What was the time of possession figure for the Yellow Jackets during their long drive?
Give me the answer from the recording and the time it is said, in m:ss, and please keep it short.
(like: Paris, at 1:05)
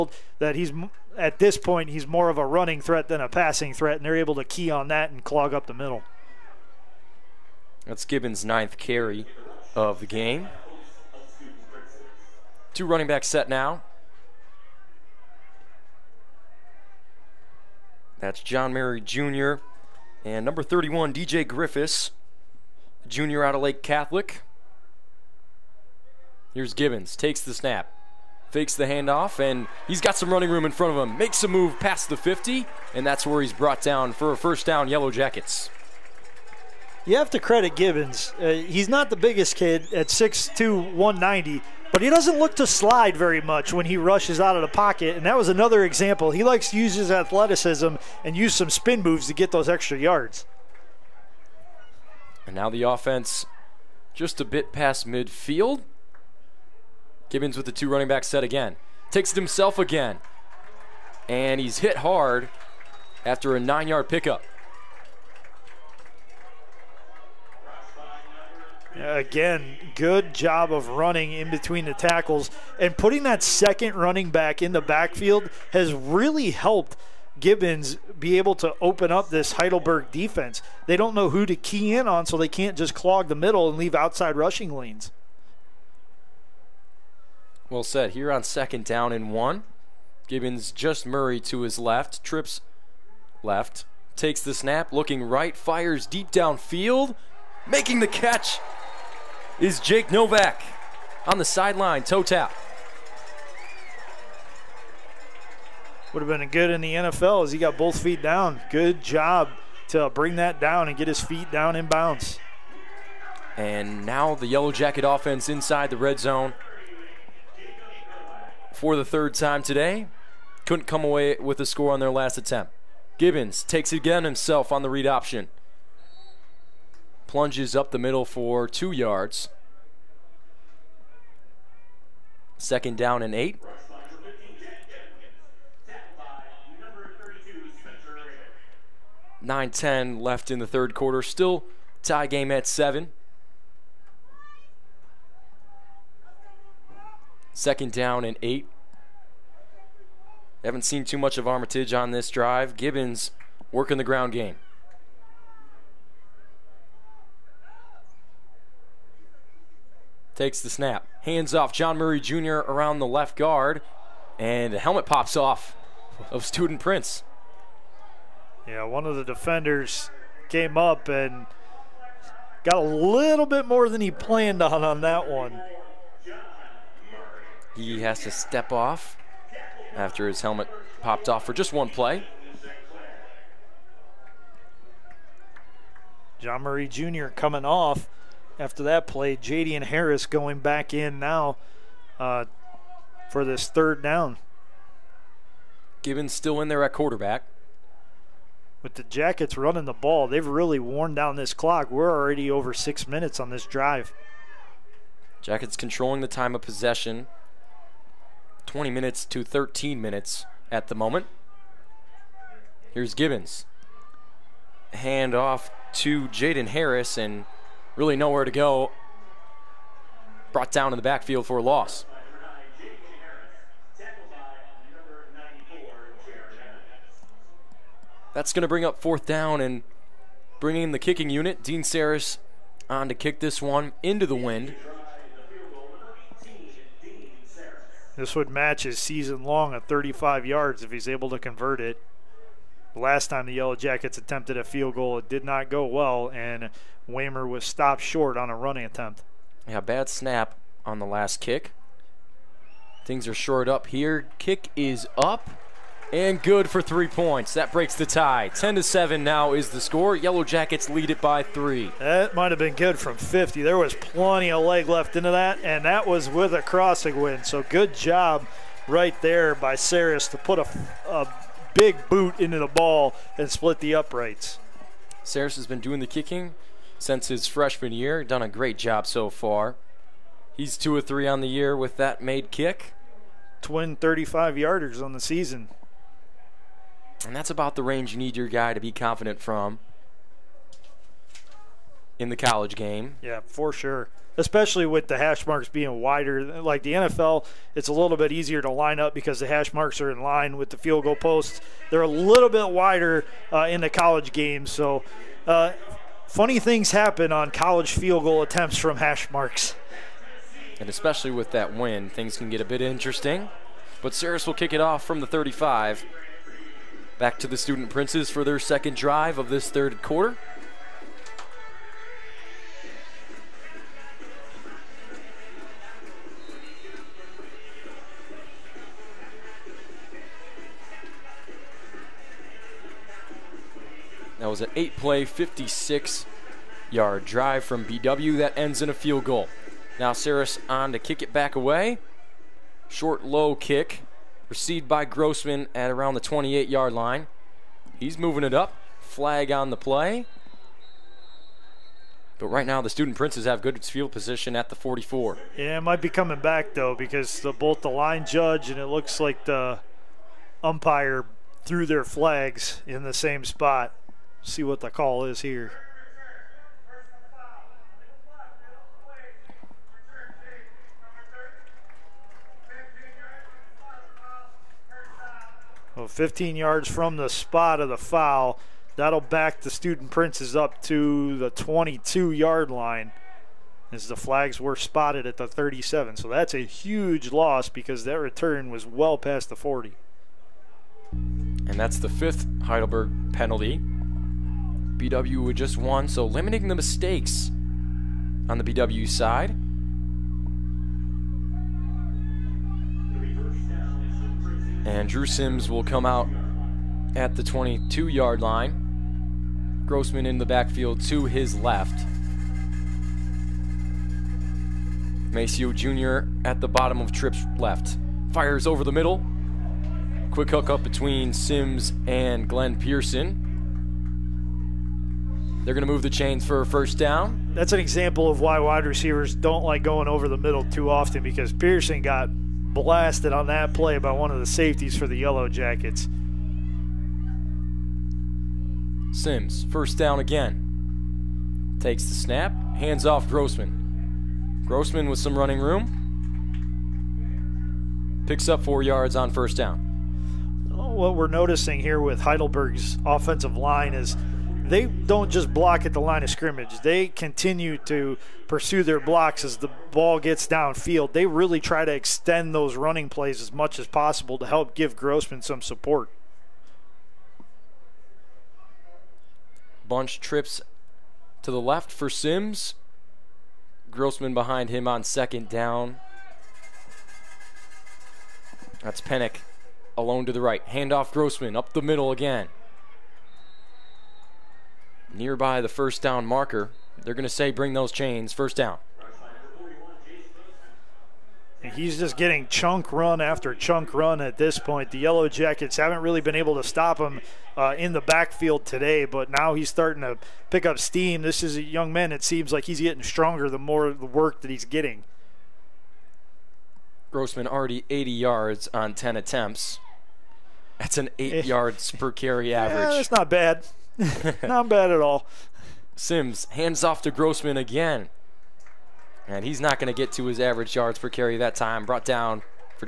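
20 minutes, at 3:28.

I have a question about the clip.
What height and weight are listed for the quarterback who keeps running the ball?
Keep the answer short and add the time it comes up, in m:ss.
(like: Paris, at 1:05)
6'2", 190, at 0:40.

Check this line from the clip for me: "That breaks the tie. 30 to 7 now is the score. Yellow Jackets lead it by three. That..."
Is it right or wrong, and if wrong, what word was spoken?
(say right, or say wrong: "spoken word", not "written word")
wrong: "10", not "30".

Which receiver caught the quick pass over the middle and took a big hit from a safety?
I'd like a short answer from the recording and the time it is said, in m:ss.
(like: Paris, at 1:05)
Glenn Pearson, at 7:02.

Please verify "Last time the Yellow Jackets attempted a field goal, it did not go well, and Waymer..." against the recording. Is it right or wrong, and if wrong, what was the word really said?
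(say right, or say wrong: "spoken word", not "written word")
right.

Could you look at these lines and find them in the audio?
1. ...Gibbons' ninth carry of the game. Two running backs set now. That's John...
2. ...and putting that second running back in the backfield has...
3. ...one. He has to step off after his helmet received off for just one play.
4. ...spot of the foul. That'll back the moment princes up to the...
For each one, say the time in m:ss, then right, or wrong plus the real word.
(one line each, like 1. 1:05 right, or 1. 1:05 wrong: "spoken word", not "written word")
1. 0:08 right
2. 1:12 right
3. 2:55 wrong: "popped", not "received"
4. 6:17 wrong: "student", not "moment".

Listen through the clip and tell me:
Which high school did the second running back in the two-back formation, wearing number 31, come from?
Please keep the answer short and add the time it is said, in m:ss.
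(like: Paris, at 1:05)
Lake Catholic, at 0:23.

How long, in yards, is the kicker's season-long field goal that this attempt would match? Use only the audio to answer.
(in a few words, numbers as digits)
35 yards.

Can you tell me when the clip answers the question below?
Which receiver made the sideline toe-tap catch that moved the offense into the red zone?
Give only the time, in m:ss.
1:39.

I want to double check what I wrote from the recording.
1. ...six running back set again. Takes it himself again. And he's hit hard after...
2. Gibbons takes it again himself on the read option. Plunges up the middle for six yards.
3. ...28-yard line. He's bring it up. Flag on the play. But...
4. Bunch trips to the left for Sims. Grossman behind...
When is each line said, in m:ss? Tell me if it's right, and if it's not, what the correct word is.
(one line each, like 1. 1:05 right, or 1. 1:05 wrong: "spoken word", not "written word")
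1. 0:57 wrong: "two", not "six"
2. 2:03 wrong: "two", not "six"
3. 5:46 wrong: "moving", not "bring"
4. 7:49 right.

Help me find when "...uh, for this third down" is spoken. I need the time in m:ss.
3:12.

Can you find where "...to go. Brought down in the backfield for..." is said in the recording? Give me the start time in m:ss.
3:38.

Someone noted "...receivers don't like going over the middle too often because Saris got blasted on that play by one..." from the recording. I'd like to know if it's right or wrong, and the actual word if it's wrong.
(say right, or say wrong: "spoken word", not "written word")
wrong: "Pearson", not "Saris".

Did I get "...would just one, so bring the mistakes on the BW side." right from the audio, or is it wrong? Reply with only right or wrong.
wrong.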